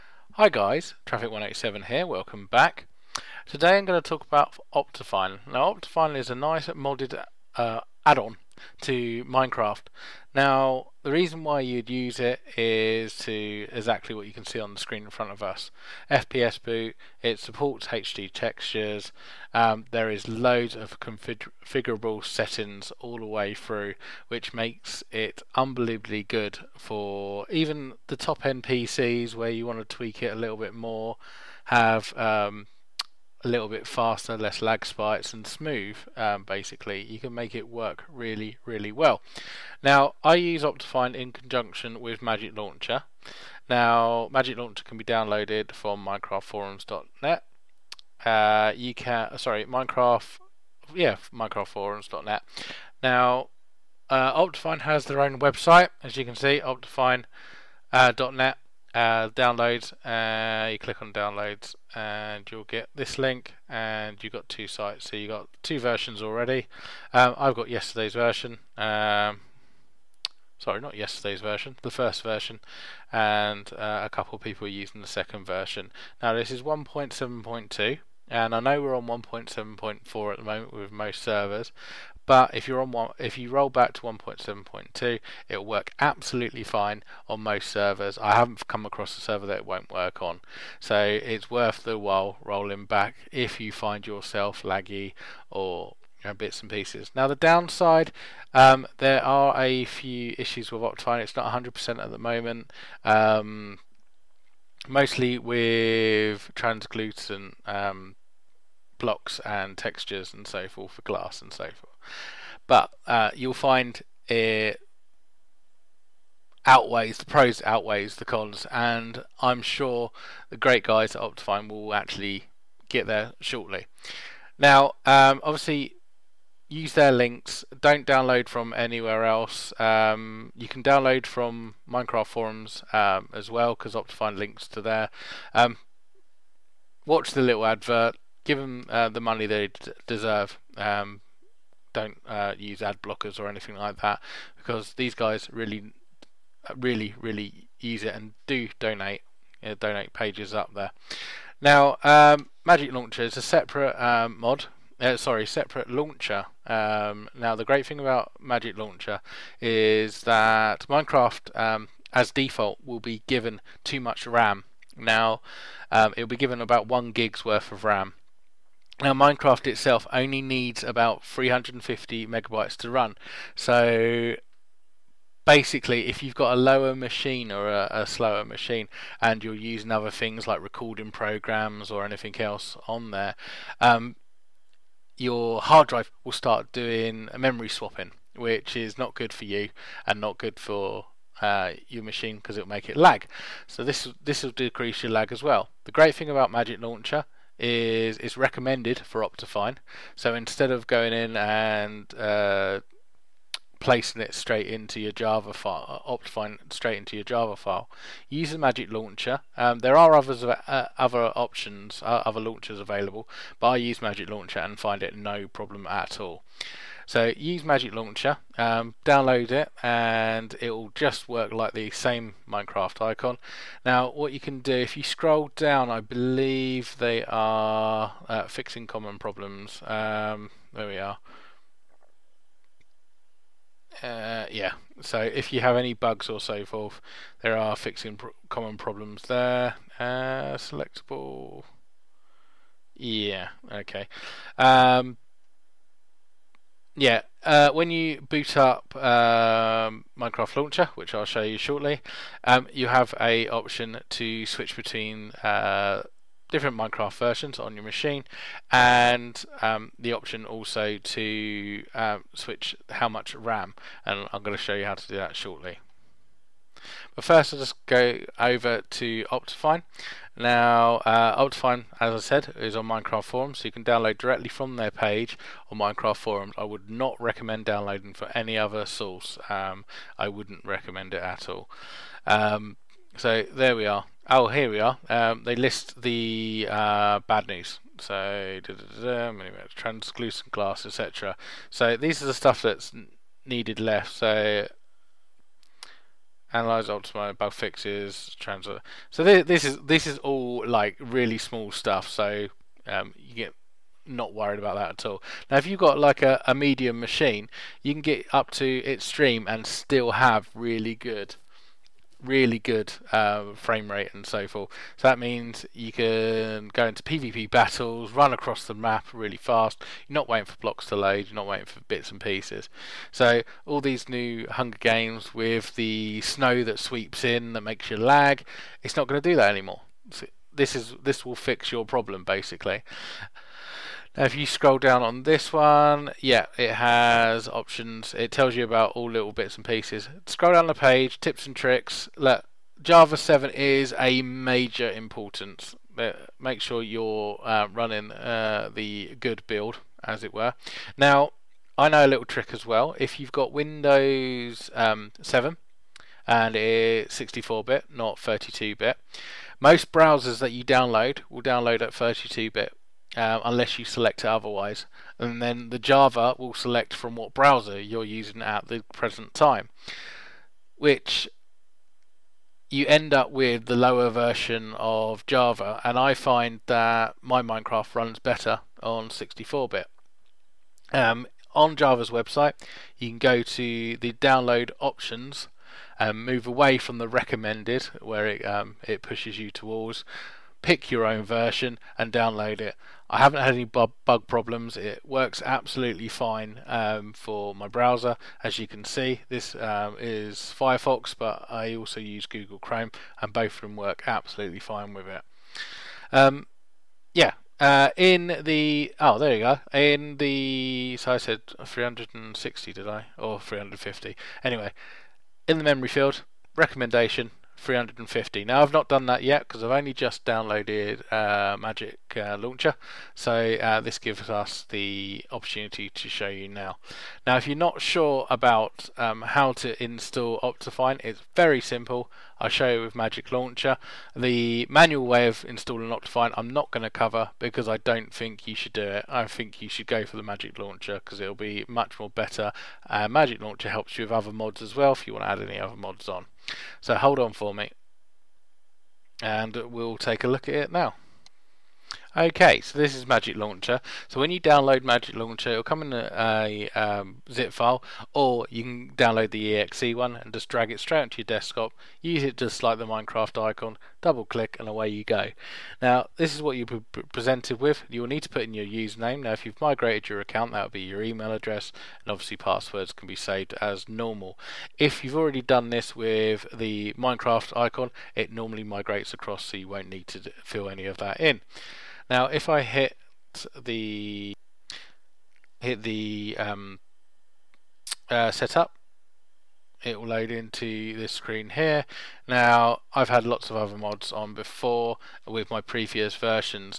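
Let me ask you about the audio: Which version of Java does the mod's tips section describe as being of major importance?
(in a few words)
Java 7.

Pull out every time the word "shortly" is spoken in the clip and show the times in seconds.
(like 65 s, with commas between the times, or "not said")
123 s, 251 s, 265 s.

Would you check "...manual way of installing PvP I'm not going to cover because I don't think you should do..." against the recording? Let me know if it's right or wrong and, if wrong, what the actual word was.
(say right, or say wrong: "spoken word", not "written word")
wrong: "Optifine", not "PvP".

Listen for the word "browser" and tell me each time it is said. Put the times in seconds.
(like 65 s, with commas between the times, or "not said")
359 s, 367 s, 397 s.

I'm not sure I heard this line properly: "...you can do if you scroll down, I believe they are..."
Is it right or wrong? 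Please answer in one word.
right.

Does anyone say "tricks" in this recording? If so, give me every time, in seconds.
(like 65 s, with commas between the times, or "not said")
341 s, 352 s.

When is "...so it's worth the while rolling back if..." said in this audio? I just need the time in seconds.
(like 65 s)
90 s.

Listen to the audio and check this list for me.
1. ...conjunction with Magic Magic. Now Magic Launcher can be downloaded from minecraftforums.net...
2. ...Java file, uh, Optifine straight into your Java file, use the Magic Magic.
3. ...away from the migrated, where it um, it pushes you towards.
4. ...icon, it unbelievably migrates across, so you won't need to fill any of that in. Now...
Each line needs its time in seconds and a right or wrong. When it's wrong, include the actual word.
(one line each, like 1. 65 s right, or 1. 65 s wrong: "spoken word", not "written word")
1. 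41 s wrong: "Launcher", not "Magic"
2. 205 s wrong: "Launcher", not "Magic"
3. 386 s wrong: "recommended", not "migrated"
4. 477 s wrong: "normally", not "unbelievably".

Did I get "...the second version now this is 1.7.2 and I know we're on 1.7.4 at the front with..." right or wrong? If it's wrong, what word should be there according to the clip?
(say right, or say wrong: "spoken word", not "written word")
wrong: "moment", not "front".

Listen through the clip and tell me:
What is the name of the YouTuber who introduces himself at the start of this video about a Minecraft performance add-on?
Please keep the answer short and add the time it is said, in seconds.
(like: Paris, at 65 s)
Traffic187, at 1 s.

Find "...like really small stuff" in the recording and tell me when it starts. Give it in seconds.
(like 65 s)
300 s.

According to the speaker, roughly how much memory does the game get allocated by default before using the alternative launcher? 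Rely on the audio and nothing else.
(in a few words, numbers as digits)
1 gig.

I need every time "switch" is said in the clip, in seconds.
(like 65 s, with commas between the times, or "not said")
254 s, 262 s.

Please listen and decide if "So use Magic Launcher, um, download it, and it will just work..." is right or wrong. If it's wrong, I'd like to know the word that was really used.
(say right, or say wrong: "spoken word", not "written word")
right.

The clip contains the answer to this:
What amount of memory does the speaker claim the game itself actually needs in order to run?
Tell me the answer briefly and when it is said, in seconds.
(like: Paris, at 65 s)
350 megabytes, at 171 s.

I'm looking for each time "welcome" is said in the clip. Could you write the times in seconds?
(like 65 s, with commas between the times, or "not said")
2 s.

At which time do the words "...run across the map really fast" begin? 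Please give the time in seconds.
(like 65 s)
318 s.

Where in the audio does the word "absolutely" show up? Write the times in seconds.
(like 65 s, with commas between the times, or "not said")
85 s, 395 s, 404 s.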